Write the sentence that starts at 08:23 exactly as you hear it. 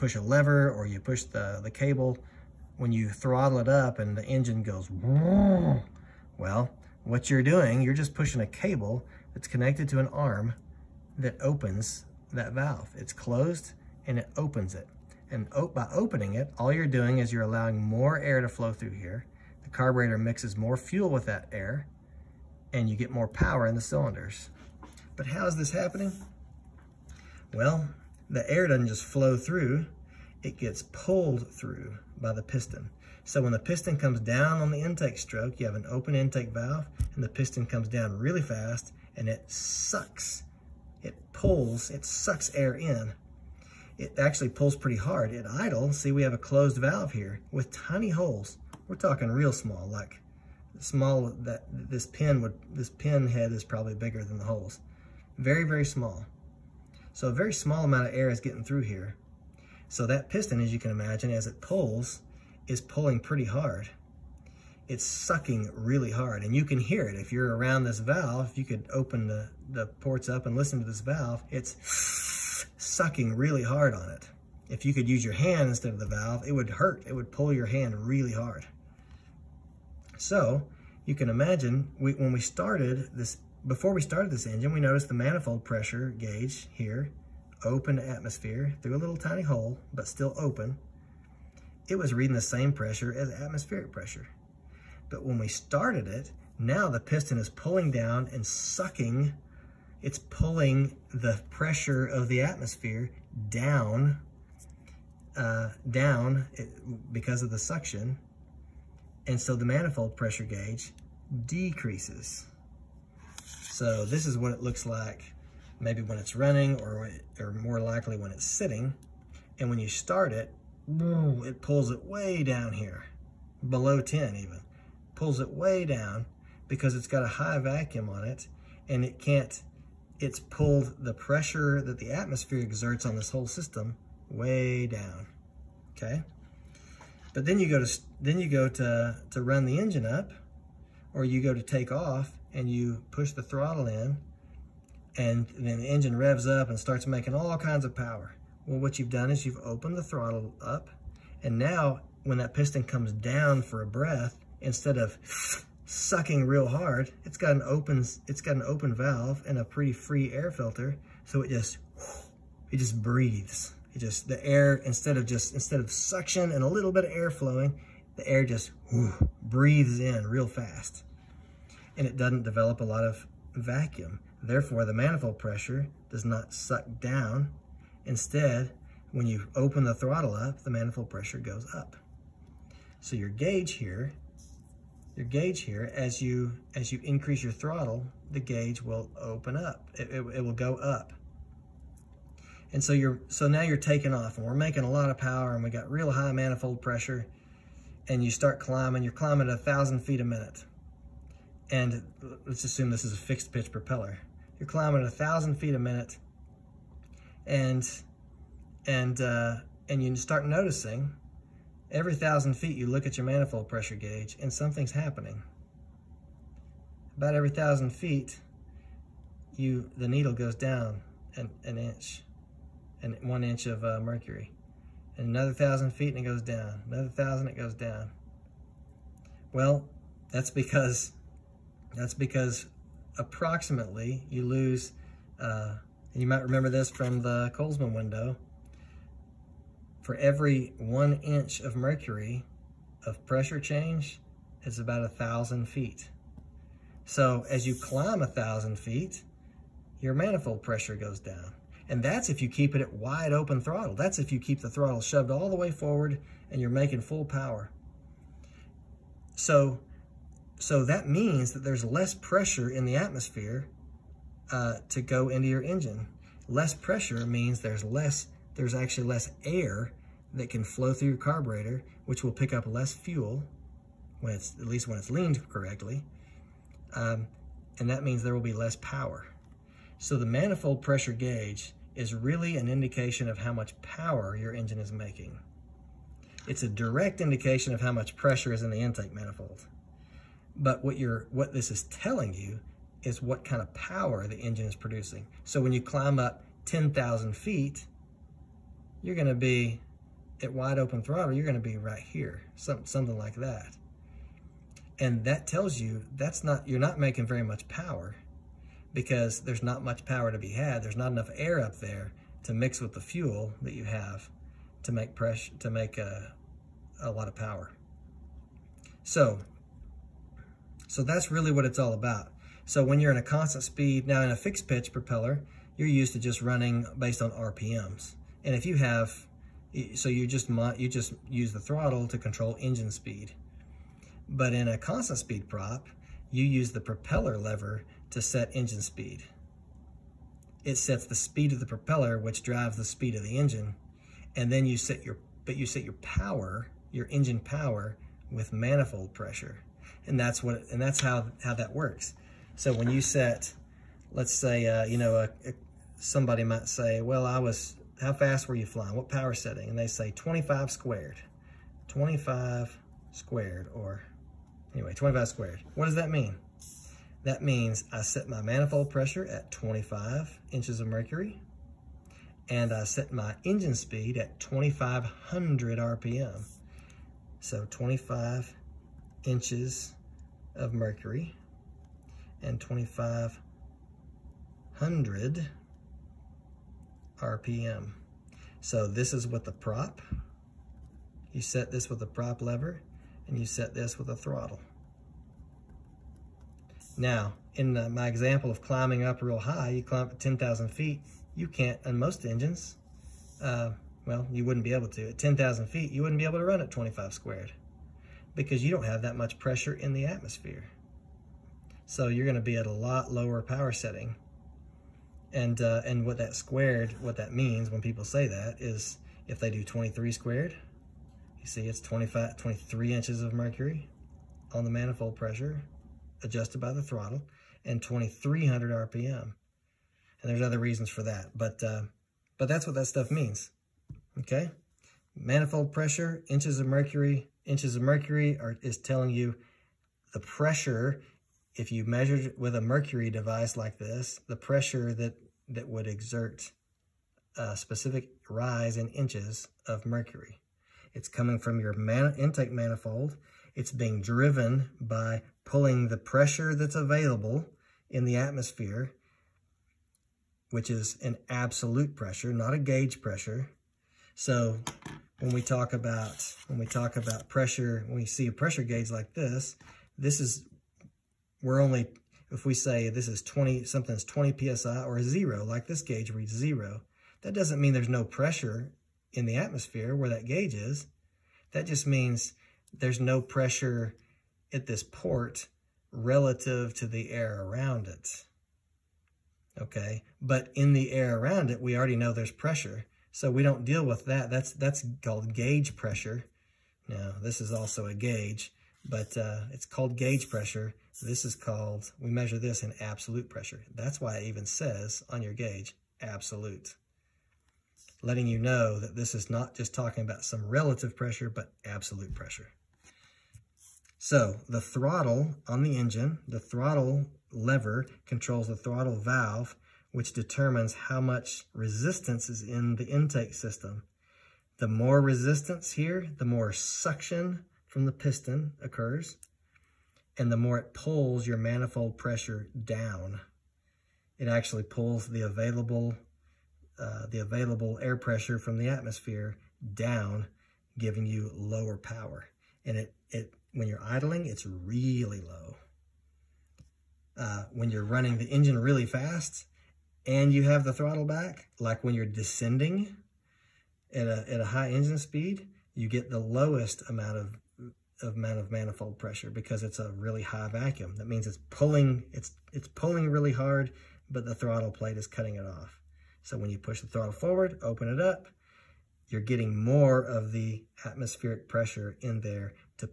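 That's why it even says on your gauge, absolute.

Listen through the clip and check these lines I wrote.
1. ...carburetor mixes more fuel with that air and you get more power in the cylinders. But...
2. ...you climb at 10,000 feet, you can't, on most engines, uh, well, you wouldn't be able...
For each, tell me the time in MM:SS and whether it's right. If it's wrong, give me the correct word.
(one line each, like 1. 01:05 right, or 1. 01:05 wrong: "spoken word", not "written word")
1. 00:19 right
2. 06:39 right.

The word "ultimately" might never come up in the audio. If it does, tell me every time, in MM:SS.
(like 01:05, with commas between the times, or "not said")
not said.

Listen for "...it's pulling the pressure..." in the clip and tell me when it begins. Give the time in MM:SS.
01:40.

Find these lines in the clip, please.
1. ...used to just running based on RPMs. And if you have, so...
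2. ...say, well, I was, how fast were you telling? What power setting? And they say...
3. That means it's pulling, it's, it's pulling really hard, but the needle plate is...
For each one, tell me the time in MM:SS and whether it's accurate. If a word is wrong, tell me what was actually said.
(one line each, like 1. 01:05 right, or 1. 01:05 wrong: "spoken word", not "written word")
1. 05:25 right
2. 05:56 wrong: "flying", not "telling"
3. 09:20 wrong: "throttle", not "needle".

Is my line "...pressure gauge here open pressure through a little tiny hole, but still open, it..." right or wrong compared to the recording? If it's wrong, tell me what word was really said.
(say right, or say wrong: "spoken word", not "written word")
wrong: "atmosphere", not "pressure".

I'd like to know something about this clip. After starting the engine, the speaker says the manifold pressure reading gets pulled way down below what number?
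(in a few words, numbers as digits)
10.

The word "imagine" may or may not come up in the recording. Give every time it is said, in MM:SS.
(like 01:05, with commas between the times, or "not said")
01:00, 01:21.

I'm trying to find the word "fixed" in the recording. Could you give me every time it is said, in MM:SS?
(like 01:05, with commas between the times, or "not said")
03:23, 05:24.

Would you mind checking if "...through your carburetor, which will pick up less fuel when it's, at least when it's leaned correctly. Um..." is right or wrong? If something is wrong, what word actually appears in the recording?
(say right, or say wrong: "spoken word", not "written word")
right.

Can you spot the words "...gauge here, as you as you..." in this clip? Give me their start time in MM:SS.
03:05.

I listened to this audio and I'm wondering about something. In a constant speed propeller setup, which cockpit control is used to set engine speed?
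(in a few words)
propeller lever.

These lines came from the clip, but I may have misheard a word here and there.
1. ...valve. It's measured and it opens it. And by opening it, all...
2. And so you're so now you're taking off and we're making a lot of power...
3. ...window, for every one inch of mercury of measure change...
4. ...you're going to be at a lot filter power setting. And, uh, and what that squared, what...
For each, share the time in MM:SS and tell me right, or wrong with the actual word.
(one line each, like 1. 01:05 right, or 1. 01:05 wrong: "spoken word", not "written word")
1. 00:12 wrong: "closed", not "measured"
2. 03:12 right
3. 03:57 wrong: "pressure", not "measure"
4. 06:52 wrong: "lower", not "filter".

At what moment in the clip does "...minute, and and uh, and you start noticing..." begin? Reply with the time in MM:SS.
03:25.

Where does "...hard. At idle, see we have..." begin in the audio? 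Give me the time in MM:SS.
00:44.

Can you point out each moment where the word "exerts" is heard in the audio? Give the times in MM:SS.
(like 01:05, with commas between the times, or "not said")
02:12, 07:25.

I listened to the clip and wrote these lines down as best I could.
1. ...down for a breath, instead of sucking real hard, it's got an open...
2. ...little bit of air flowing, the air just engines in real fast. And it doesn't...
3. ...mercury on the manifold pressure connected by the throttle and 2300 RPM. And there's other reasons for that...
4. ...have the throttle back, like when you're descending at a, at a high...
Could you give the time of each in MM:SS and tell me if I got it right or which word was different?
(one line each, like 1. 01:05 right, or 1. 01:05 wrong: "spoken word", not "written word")
1. 02:33 right
2. 02:46 wrong: "breathes", not "engines"
3. 07:03 wrong: "adjusted", not "connected"
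4. 09:10 right.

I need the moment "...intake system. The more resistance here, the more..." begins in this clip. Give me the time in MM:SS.
08:42.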